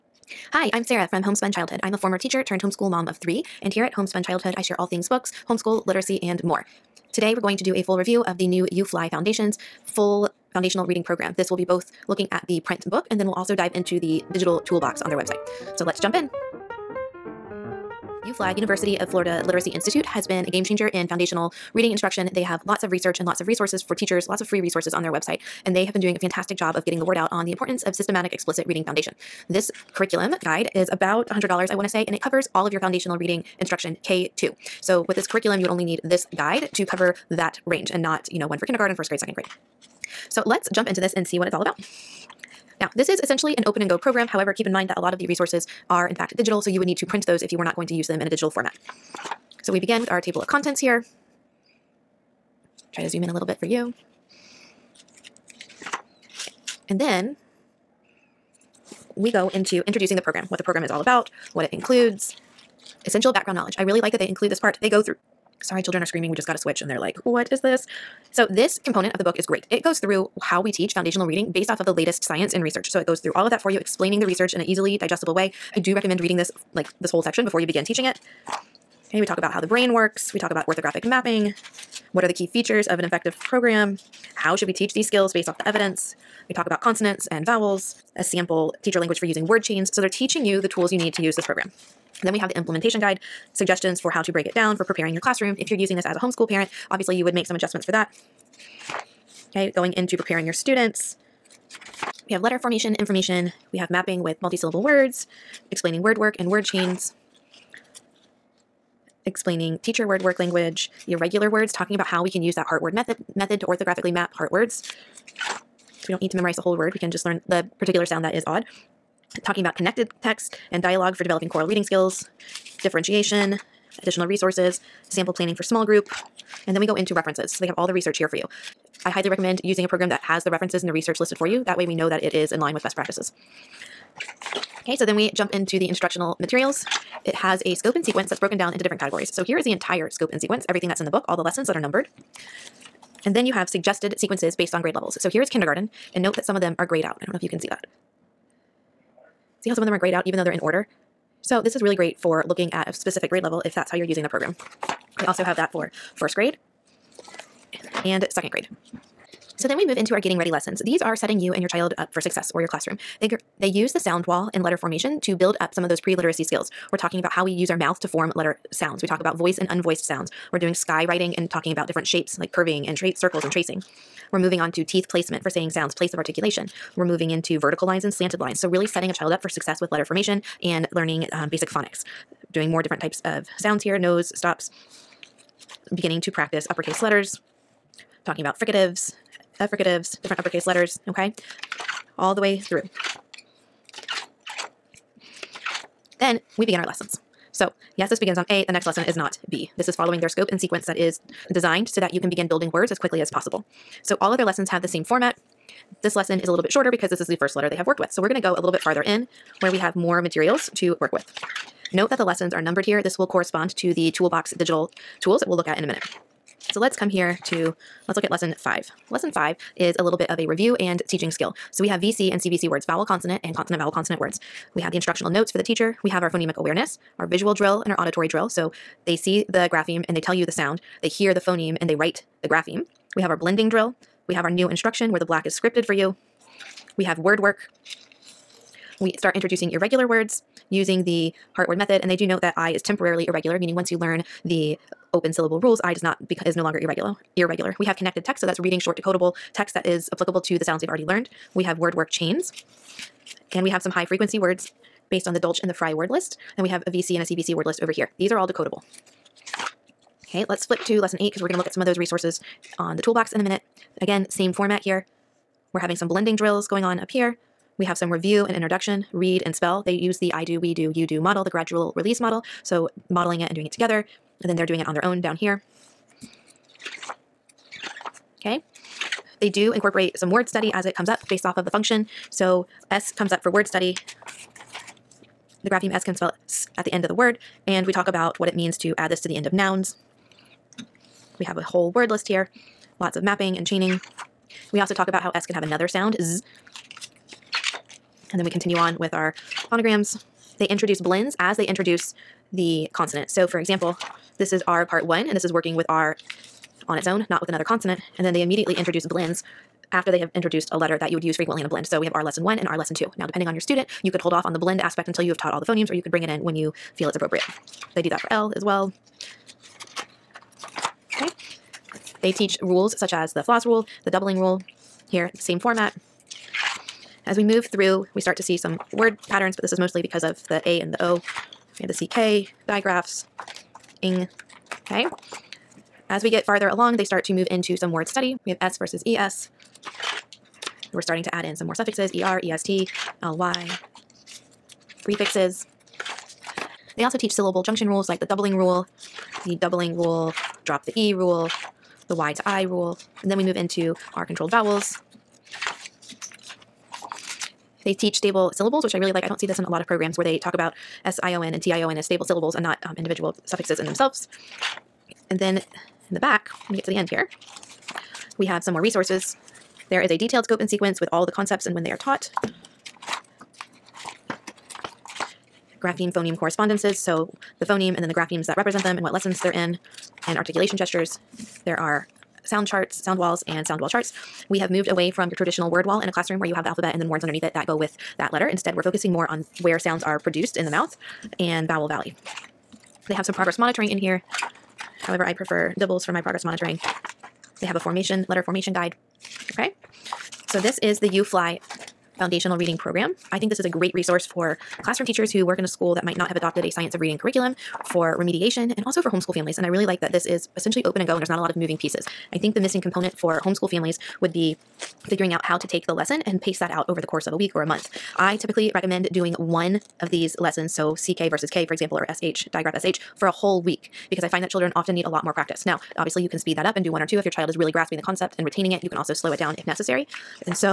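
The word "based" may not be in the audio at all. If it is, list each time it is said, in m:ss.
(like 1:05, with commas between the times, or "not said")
1:11, 1:25, 2:24, 4:15, 4:41.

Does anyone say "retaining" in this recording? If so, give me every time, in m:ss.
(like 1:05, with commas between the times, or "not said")
7:08.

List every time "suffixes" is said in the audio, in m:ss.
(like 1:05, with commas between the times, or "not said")
5:41, 6:03.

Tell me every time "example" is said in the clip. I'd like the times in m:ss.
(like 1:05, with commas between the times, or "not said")
5:03, 7:01.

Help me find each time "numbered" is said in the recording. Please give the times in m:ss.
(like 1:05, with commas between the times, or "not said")
2:21, 3:32.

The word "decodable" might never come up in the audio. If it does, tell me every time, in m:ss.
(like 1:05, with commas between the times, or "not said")
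4:08, 4:18.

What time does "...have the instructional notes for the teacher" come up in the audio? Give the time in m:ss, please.
3:44.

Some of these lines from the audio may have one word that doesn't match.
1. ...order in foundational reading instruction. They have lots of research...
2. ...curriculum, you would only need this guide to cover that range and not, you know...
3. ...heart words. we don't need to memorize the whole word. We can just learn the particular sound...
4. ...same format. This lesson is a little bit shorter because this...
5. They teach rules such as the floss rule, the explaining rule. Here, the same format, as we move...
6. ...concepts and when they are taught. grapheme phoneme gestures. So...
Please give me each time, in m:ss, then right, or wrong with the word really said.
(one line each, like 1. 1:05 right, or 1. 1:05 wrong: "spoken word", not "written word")
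1. 0:20 wrong: "changer", not "order"
2. 0:35 right
3. 1:54 right
4. 3:24 right
5. 5:22 wrong: "doubling", not "explaining"
6. 6:11 wrong: "correspondences", not "gestures".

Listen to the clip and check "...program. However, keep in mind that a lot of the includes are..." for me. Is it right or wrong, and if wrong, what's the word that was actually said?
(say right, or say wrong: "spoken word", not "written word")
wrong: "resources", not "includes".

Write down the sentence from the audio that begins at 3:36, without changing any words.
So let's come here to, let's look at lesson five.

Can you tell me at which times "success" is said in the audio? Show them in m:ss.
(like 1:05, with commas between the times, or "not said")
2:42, 2:59.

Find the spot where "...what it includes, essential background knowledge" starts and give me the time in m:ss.
1:01.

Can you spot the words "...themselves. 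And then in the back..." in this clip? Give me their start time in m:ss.
6:03.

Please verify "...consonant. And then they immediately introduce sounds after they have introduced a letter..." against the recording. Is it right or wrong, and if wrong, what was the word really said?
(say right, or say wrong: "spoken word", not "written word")
wrong: "blends", not "sounds".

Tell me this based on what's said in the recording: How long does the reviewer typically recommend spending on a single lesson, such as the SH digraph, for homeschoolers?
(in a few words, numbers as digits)
a whole week.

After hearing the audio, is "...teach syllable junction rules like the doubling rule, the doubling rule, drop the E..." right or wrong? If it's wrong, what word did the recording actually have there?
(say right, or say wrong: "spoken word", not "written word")
right.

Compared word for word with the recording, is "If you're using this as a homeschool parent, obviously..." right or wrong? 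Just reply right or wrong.
right.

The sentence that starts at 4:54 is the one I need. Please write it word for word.
We also talk about how S can have another sound, Z.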